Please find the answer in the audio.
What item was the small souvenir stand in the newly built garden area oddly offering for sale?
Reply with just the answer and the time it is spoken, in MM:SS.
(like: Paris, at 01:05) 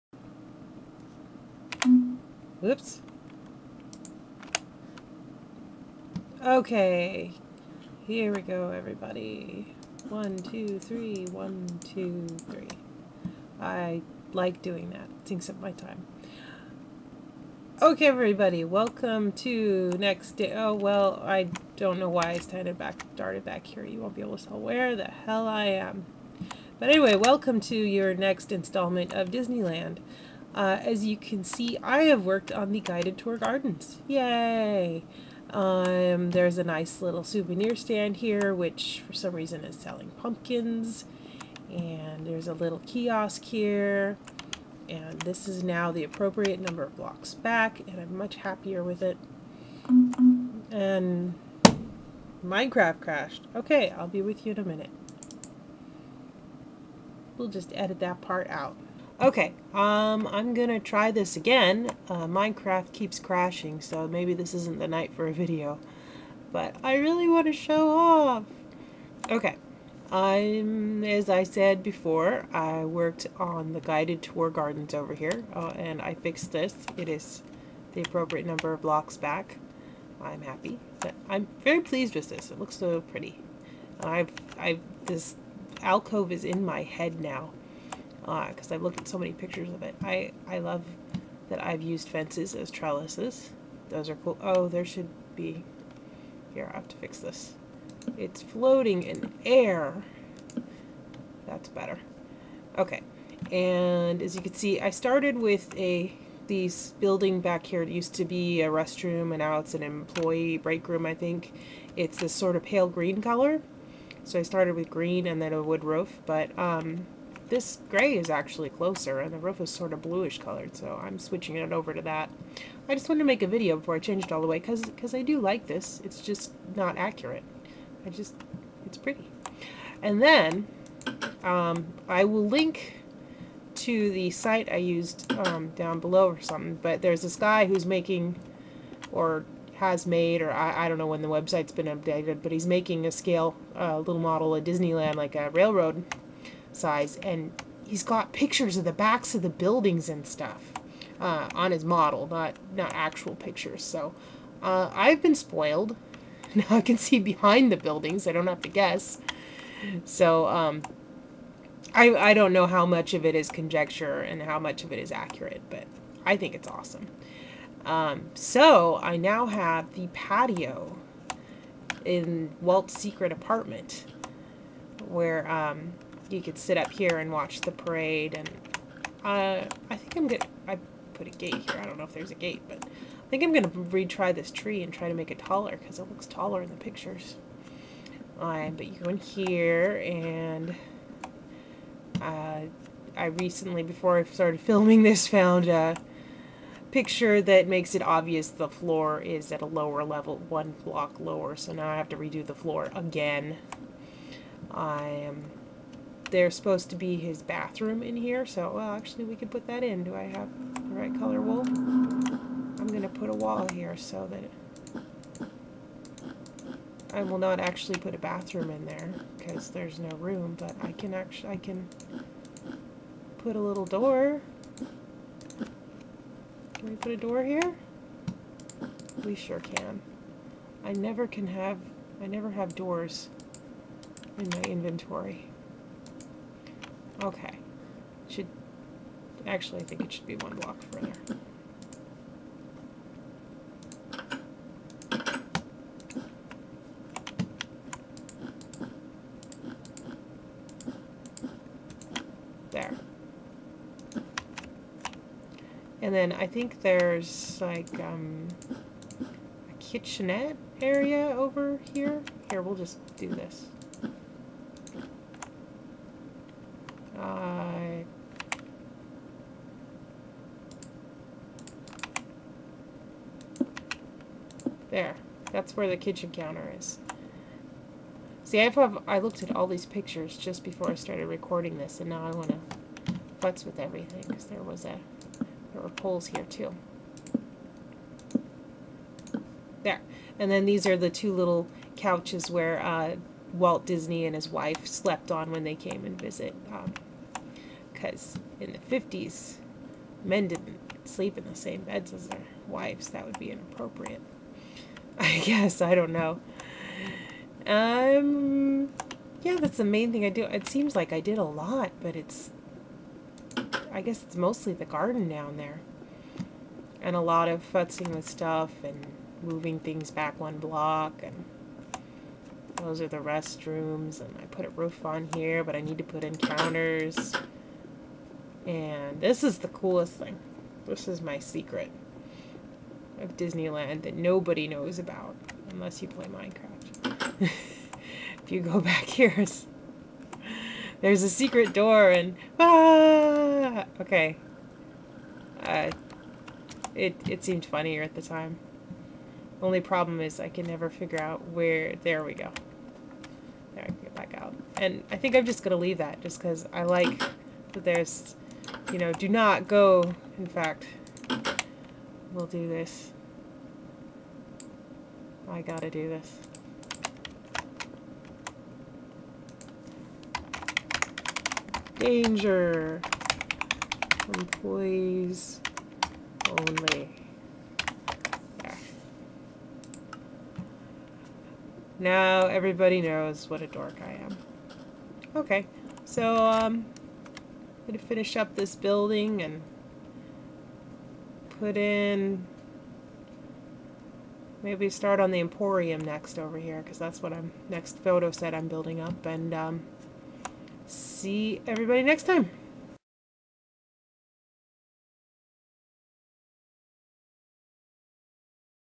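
pumpkins, at 00:40.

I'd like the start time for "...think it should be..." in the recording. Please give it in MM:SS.
03:59.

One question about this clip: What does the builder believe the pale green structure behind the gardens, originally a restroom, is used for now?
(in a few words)
employee break room.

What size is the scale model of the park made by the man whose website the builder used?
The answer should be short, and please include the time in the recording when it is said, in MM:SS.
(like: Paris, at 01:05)
railroad size, at 02:25.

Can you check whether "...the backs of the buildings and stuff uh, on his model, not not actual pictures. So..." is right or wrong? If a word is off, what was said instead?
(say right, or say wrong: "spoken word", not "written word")
right.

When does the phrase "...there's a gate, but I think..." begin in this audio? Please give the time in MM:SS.
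03:02.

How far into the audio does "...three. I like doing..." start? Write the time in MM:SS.
00:12.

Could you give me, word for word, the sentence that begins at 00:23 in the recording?
You won't be able to tell where the hell I am.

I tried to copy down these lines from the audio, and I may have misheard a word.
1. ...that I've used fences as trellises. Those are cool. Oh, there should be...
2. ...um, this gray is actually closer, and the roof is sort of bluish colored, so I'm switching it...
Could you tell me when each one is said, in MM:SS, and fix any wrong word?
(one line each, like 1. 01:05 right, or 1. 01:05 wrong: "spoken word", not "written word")
1. 01:31 right
2. 01:56 right.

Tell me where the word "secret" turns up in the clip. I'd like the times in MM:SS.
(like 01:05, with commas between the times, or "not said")
02:52, 05:31, 05:41.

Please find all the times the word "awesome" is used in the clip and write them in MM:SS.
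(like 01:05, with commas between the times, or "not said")
02:46.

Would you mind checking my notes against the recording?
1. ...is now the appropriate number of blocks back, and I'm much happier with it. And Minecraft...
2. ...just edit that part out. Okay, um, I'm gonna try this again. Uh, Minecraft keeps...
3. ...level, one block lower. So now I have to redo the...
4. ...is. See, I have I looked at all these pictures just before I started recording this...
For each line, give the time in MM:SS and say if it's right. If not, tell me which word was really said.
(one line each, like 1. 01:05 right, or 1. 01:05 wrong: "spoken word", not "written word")
1. 00:45 right
2. 00:57 right
3. 03:20 right
4. 04:36 right.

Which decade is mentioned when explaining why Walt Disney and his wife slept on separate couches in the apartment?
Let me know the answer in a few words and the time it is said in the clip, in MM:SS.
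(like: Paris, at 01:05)
the fifties, at 04:58.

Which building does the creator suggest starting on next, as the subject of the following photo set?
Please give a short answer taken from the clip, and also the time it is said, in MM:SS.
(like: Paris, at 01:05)
the Emporium, at 06:35.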